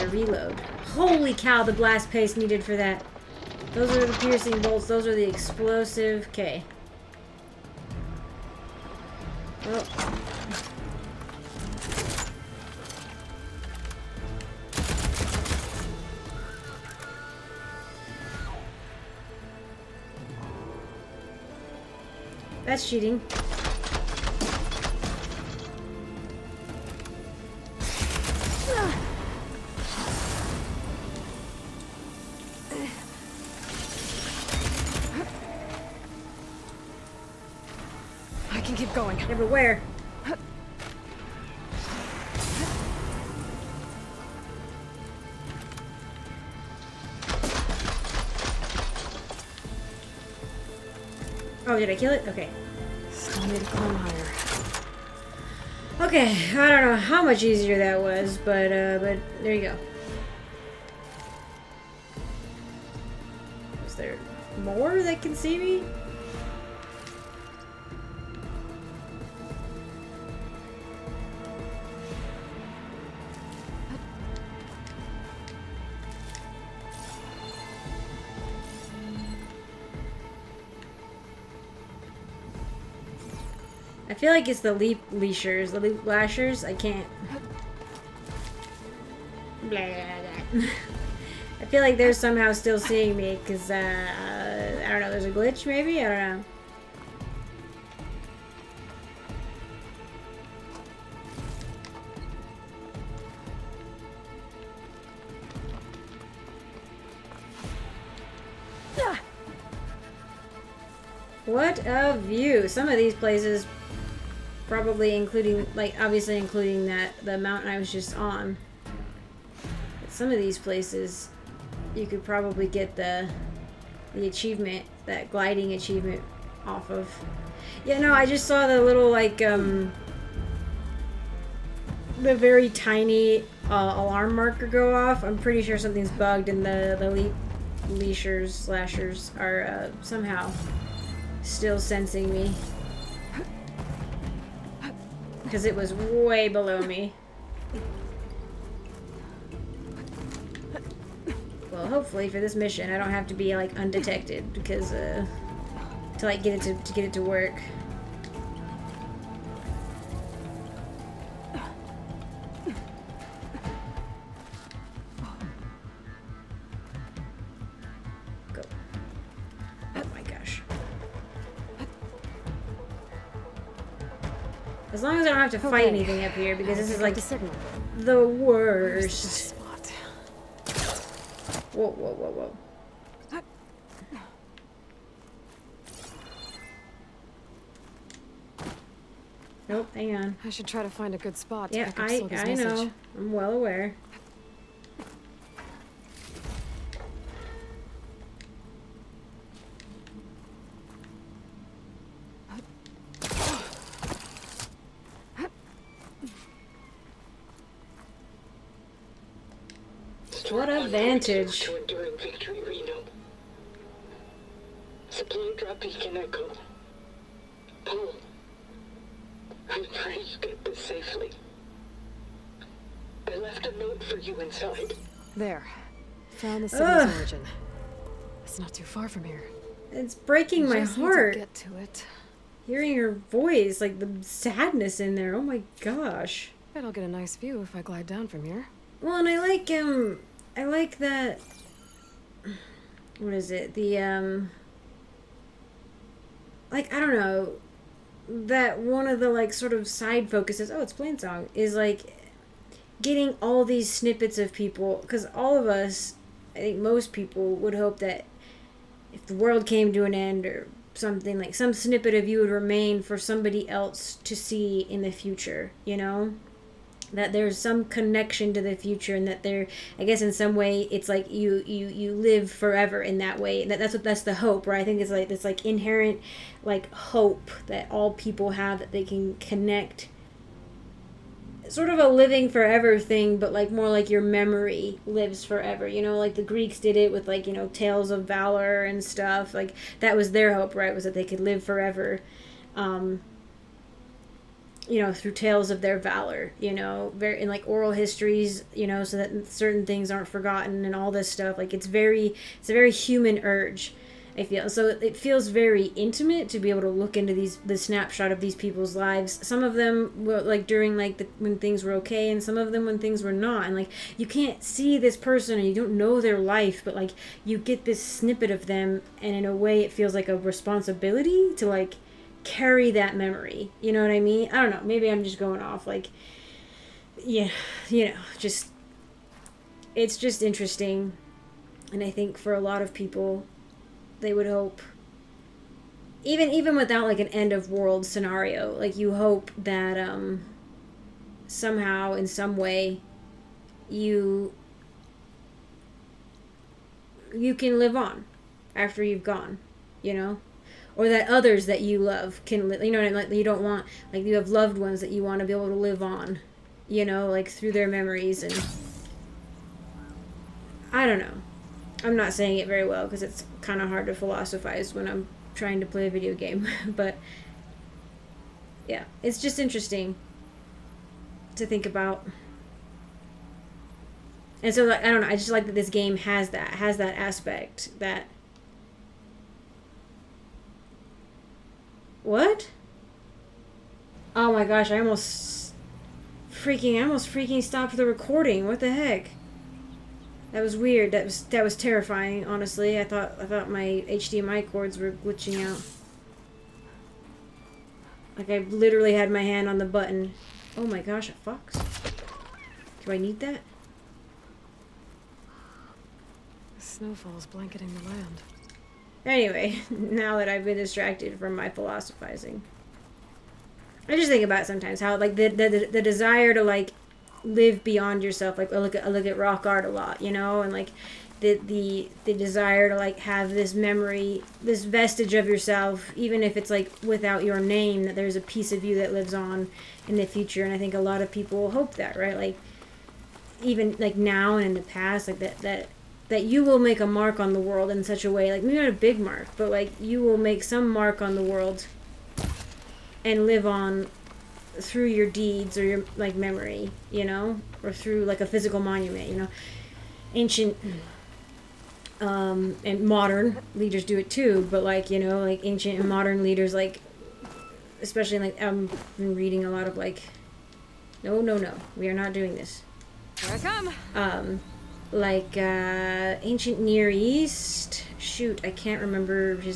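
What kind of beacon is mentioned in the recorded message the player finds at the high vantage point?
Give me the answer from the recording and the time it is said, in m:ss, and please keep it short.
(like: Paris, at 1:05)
Supply drop beacon, at 3:35.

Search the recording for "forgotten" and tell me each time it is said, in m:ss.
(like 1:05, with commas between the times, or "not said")
5:00.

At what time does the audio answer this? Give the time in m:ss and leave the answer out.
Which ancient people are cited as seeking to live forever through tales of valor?
4:46.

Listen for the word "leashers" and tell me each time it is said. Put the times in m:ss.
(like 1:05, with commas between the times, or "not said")
1:25, 2:17.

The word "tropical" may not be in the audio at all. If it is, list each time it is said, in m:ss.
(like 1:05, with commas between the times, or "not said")
not said.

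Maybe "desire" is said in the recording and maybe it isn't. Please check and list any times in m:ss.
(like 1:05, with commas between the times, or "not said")
6:56, 7:02.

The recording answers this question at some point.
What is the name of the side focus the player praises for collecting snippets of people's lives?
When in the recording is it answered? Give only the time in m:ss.
4:10.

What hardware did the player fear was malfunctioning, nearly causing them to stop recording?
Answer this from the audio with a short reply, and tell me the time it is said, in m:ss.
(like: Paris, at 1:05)
HDMI cords, at 6:34.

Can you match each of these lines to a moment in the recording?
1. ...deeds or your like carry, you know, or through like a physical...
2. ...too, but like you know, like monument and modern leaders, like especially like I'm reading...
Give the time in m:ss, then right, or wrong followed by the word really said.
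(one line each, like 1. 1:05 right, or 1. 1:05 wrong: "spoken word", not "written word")
1. 7:25 wrong: "memory", not "carry"
2. 7:34 wrong: "ancient", not "monument".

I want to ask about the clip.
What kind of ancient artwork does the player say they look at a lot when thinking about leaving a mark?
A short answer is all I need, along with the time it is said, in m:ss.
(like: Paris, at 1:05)
Rock art, at 6:59.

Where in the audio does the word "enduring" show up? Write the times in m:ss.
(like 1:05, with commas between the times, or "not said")
3:31.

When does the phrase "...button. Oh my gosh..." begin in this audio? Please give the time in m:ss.
6:39.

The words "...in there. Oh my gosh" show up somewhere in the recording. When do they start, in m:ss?
3:54.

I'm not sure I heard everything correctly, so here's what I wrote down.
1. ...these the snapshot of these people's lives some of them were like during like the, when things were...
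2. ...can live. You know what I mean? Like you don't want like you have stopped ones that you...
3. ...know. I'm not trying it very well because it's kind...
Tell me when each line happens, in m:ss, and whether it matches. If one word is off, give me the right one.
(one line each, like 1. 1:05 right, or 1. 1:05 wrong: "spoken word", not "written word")
1. 5:07 right
2. 5:52 wrong: "loved", not "stopped"
3. 6:01 wrong: "saying", not "trying".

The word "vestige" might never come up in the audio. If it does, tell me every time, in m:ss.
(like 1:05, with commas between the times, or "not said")
7:04.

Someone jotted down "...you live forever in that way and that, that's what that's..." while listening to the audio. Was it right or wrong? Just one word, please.
right.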